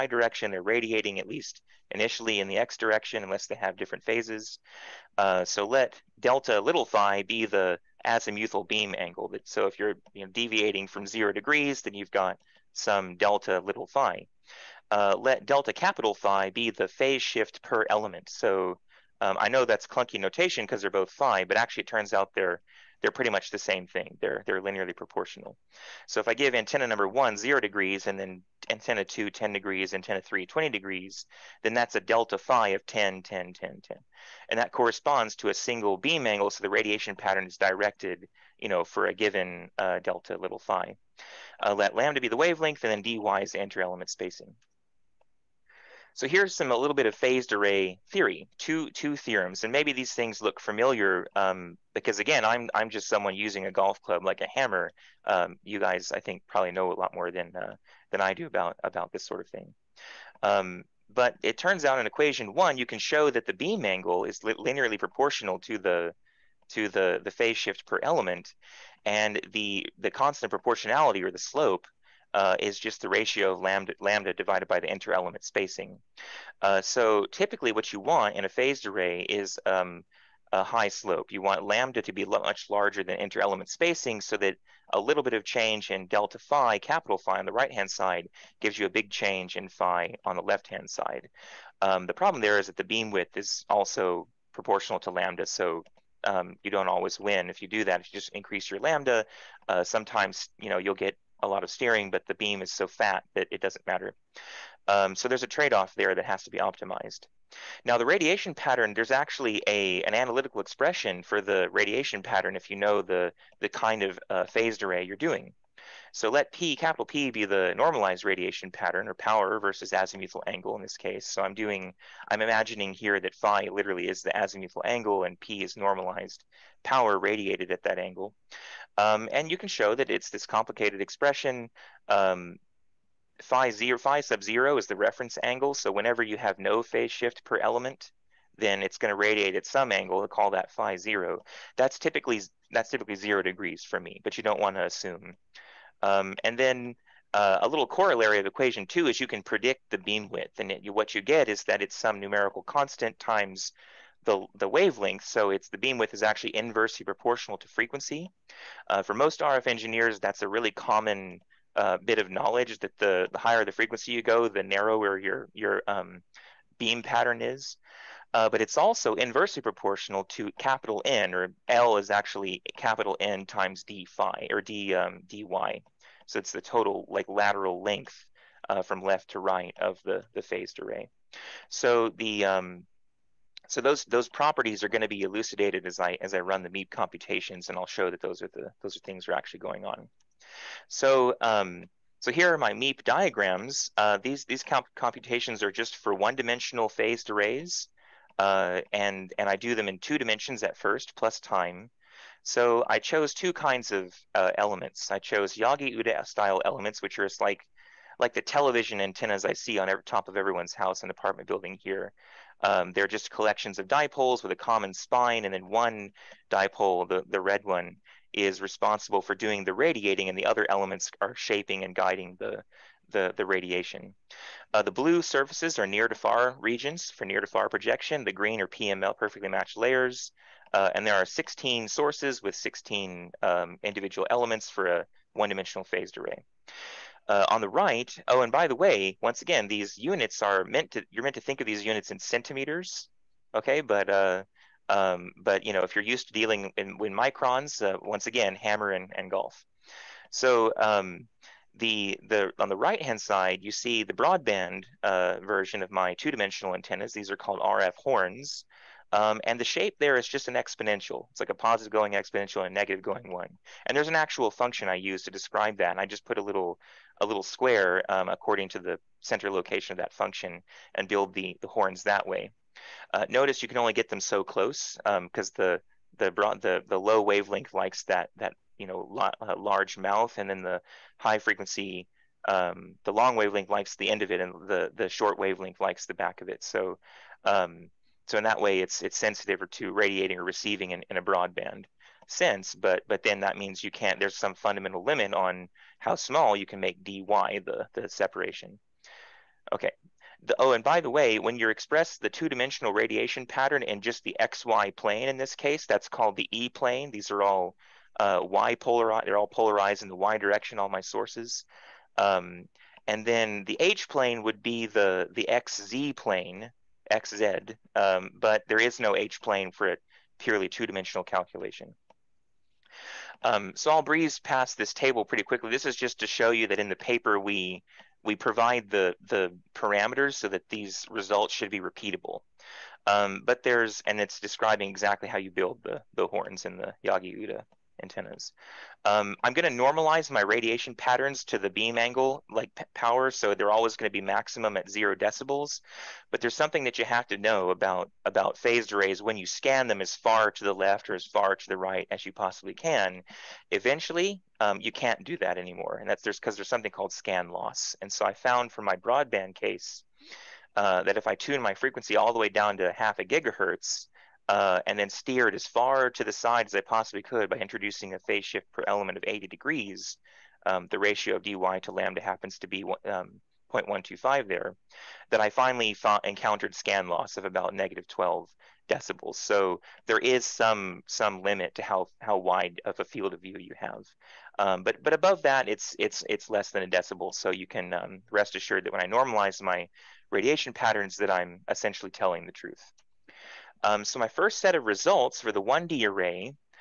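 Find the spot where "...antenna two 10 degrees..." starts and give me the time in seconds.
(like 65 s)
28 s.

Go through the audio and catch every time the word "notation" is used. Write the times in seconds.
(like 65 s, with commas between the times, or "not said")
20 s.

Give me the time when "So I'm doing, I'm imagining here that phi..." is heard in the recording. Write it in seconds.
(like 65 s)
121 s.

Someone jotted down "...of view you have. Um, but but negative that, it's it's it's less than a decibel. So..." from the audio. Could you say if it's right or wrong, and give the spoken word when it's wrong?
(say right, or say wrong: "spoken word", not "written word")
wrong: "above", not "negative".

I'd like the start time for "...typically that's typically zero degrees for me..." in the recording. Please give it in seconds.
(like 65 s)
141 s.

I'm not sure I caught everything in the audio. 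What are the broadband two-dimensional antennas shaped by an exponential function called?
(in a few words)
RF horns.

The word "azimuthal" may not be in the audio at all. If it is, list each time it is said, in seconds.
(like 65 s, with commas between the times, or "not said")
8 s, 119 s, 124 s.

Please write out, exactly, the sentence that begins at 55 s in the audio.
Um, you guys, I think, probably know a lot more than uh, than I do about about this sort of thing.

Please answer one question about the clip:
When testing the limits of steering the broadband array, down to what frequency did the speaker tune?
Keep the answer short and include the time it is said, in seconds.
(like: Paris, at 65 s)
half a gigahertz, at 362 s.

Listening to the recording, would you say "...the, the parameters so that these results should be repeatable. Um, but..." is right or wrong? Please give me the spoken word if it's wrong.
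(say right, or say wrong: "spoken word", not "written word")
right.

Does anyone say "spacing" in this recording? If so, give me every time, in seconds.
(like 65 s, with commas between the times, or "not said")
44 s, 75 s, 83 s.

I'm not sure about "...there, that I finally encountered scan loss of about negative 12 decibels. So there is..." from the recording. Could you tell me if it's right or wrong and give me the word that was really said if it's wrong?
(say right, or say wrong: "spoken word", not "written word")
right.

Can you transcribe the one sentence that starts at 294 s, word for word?
There's some fundamental limit on how small you can make dy the the separation.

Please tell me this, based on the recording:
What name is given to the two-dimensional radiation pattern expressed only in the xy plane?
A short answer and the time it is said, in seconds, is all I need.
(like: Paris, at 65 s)
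E plane, at 306 s.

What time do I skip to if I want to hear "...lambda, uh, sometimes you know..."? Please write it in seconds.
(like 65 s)
98 s.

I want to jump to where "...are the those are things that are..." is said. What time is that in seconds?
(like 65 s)
188 s.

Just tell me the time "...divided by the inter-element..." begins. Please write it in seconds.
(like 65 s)
74 s.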